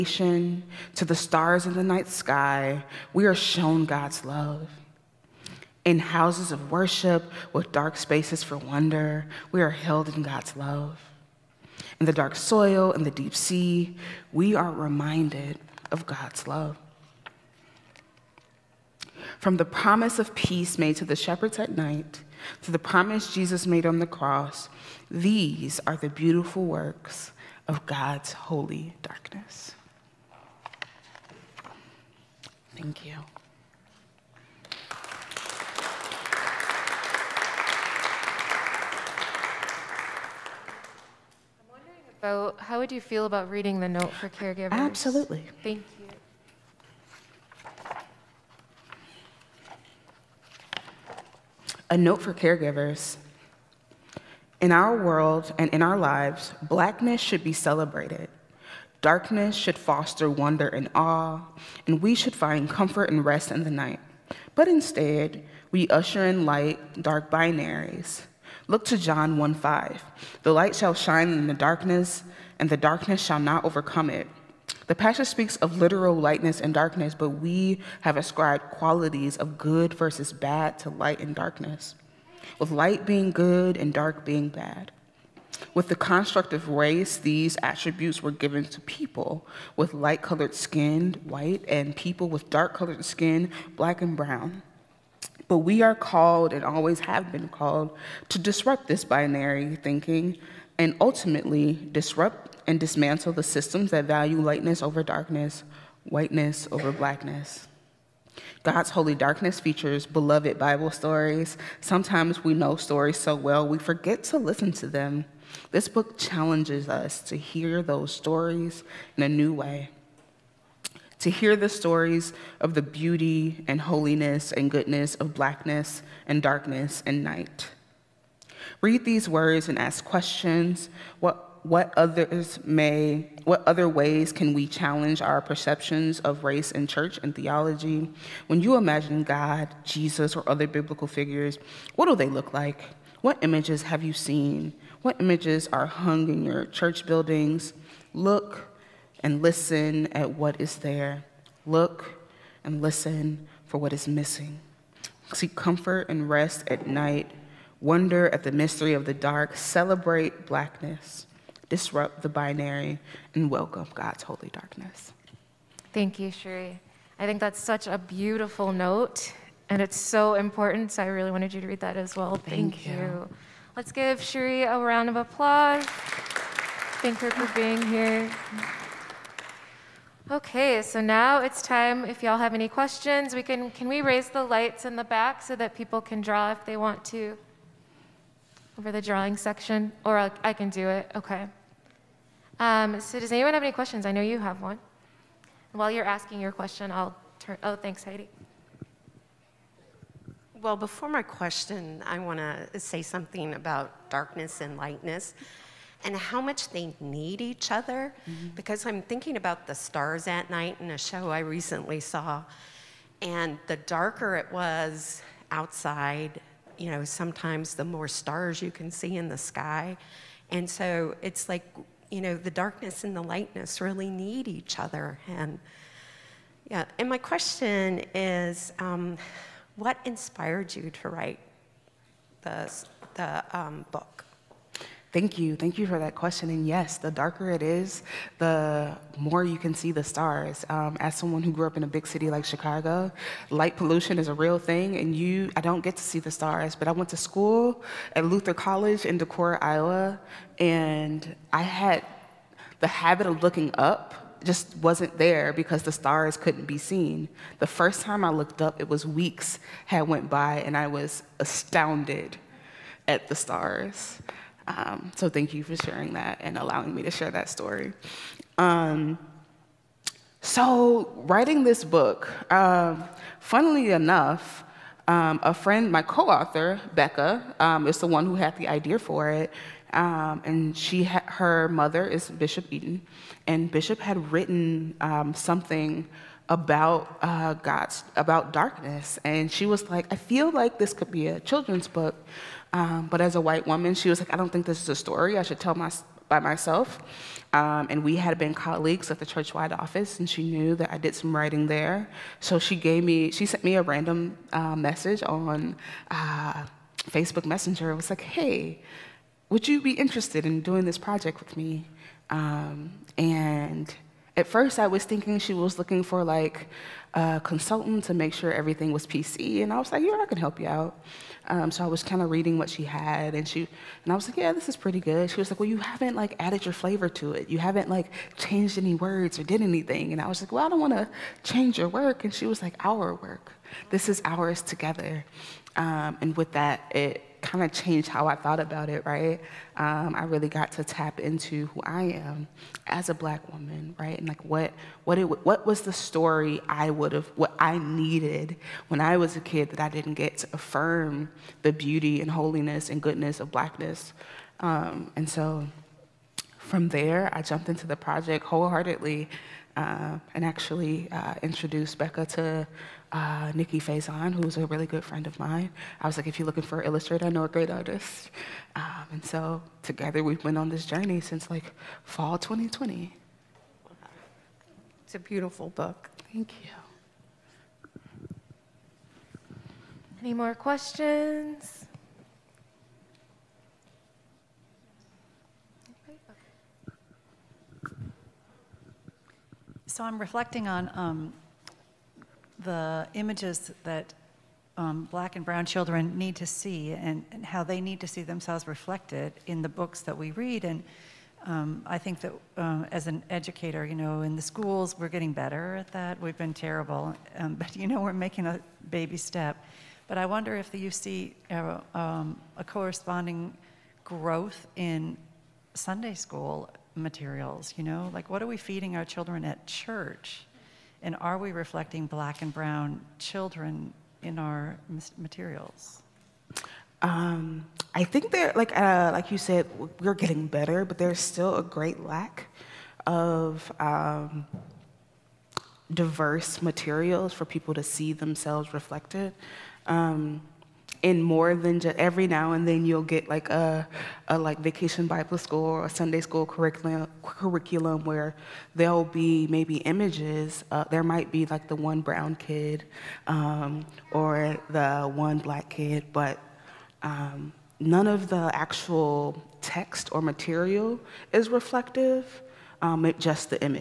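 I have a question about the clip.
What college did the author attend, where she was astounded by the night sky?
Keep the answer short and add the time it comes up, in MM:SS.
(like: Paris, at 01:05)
Luther College, at 04:08.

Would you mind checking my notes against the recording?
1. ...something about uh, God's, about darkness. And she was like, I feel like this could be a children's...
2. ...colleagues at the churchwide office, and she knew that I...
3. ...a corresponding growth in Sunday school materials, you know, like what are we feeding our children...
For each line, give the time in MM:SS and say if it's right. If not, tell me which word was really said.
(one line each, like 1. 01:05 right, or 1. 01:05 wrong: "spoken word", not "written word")
1. 04:45 right
2. 04:58 right
3. 06:52 right.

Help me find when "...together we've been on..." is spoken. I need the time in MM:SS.
06:09.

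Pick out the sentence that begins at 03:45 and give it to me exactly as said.
And yeah, and my question is um, what inspired you to write the, the um, book?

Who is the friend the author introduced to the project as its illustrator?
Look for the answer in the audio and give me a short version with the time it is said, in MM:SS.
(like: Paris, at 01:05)
Nikki Faison, at 06:03.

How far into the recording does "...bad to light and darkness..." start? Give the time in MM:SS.
01:20.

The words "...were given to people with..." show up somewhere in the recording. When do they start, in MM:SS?
01:28.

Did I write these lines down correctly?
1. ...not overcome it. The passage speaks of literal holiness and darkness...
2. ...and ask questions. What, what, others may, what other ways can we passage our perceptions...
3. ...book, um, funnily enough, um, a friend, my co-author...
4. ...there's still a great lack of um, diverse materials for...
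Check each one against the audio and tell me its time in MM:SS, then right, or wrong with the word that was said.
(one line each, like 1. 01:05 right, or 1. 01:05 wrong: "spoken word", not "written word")
1. 01:13 wrong: "lightness", not "holiness"
2. 02:09 wrong: "challenge", not "passage"
3. 04:31 right
4. 07:10 right.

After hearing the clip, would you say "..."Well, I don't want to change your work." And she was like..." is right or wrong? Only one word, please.
right.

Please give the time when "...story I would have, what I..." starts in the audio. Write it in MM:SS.
05:45.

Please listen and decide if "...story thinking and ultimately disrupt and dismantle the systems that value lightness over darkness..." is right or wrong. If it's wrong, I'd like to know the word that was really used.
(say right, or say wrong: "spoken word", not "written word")
wrong: "binary", not "story".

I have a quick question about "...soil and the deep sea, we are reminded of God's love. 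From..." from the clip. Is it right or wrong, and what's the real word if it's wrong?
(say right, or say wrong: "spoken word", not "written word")
right.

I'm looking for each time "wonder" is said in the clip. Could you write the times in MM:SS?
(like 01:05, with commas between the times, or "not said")
00:08, 01:00, 02:37, 06:50.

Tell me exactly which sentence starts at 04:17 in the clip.
The first time I looked up, it was weeks had went by, and I was astounded at the stars.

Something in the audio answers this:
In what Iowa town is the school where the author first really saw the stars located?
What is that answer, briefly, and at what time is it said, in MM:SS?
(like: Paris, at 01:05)
Decorah, at 04:09.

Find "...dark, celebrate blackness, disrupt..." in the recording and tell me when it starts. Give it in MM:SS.
02:39.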